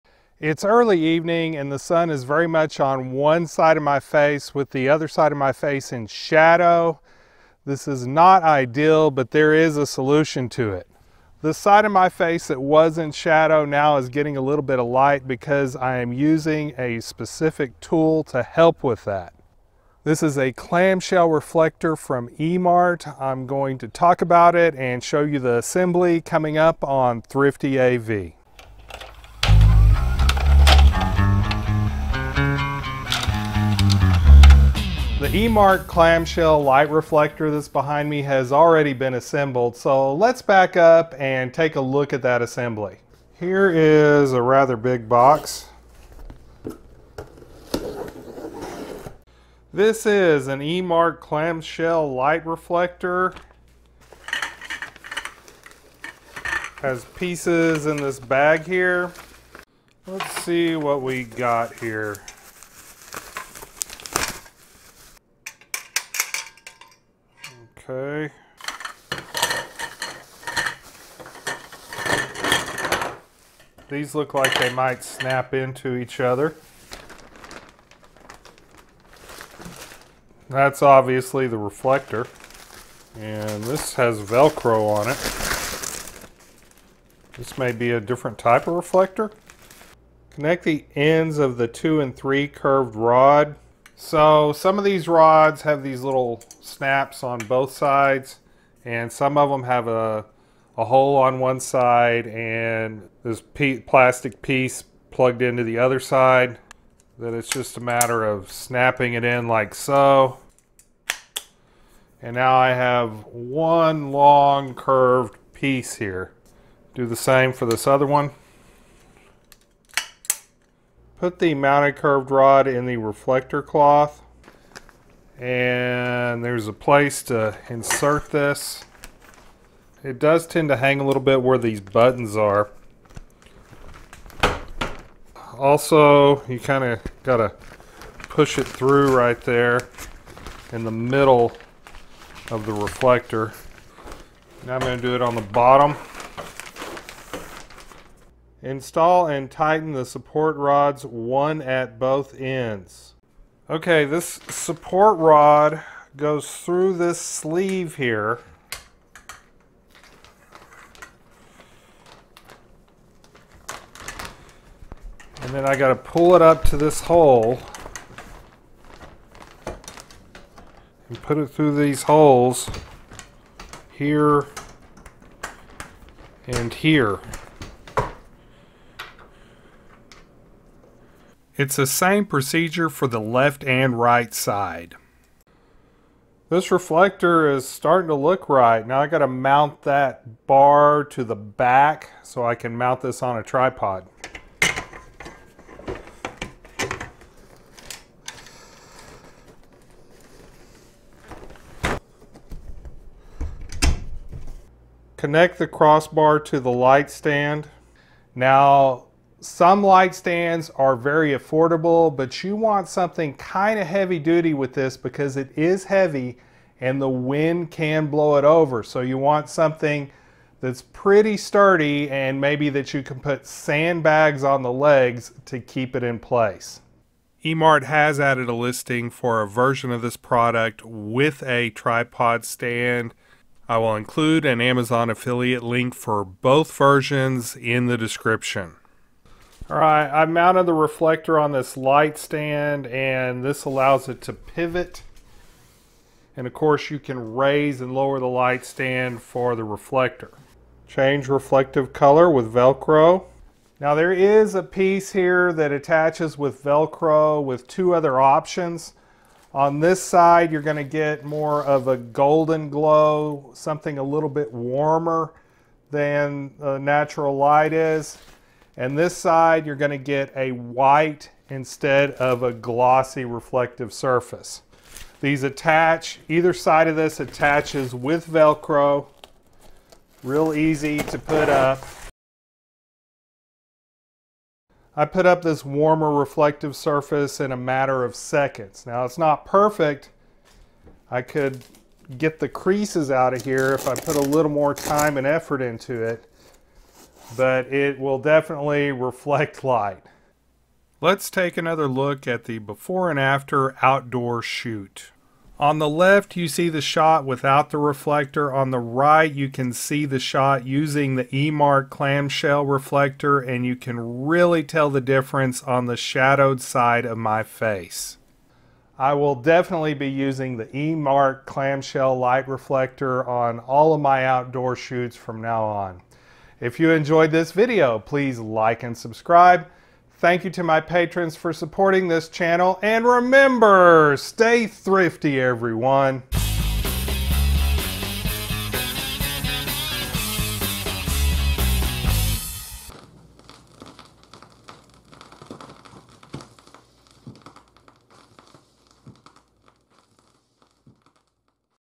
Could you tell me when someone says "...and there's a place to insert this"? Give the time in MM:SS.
02:05.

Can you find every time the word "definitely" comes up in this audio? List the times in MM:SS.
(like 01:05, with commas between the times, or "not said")
04:58, 05:19.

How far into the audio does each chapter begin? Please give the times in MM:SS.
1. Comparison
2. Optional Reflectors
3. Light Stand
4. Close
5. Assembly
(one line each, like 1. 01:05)
1. 05:00
2. 04:10
3. 03:24
4. 05:26
5. 00:43.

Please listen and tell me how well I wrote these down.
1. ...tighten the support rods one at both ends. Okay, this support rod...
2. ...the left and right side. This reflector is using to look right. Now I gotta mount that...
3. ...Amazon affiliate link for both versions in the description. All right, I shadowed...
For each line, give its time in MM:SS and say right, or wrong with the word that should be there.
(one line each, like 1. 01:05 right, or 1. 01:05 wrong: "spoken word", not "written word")
1. 02:29 right
2. 03:03 wrong: "starting", not "using"
3. 03:54 wrong: "mounted", not "shadowed".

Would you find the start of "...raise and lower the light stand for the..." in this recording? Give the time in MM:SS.
04:07.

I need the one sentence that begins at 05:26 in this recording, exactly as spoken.
If you enjoyed this video, please like and subscribe.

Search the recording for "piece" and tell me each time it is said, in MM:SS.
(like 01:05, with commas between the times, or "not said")
00:57, 01:44, 01:55, 04:14.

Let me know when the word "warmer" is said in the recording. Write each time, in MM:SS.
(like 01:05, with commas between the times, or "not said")
04:24, 04:45.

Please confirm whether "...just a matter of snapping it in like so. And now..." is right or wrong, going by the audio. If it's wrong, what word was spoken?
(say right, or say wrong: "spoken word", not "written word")
right.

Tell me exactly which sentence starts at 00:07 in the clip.
This is not ideal, but there is a solution to it.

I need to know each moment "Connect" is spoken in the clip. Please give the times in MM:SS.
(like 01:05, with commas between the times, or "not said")
01:30, 03:25.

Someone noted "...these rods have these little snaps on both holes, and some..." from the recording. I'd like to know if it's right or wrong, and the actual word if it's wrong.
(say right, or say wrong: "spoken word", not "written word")
wrong: "sides", not "holes".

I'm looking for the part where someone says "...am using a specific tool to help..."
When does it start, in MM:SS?
00:15.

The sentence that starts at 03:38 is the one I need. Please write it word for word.
So you want something that's pretty sturdy and maybe that you can put sandbags on the legs to keep it in place.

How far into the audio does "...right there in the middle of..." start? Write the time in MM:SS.
02:19.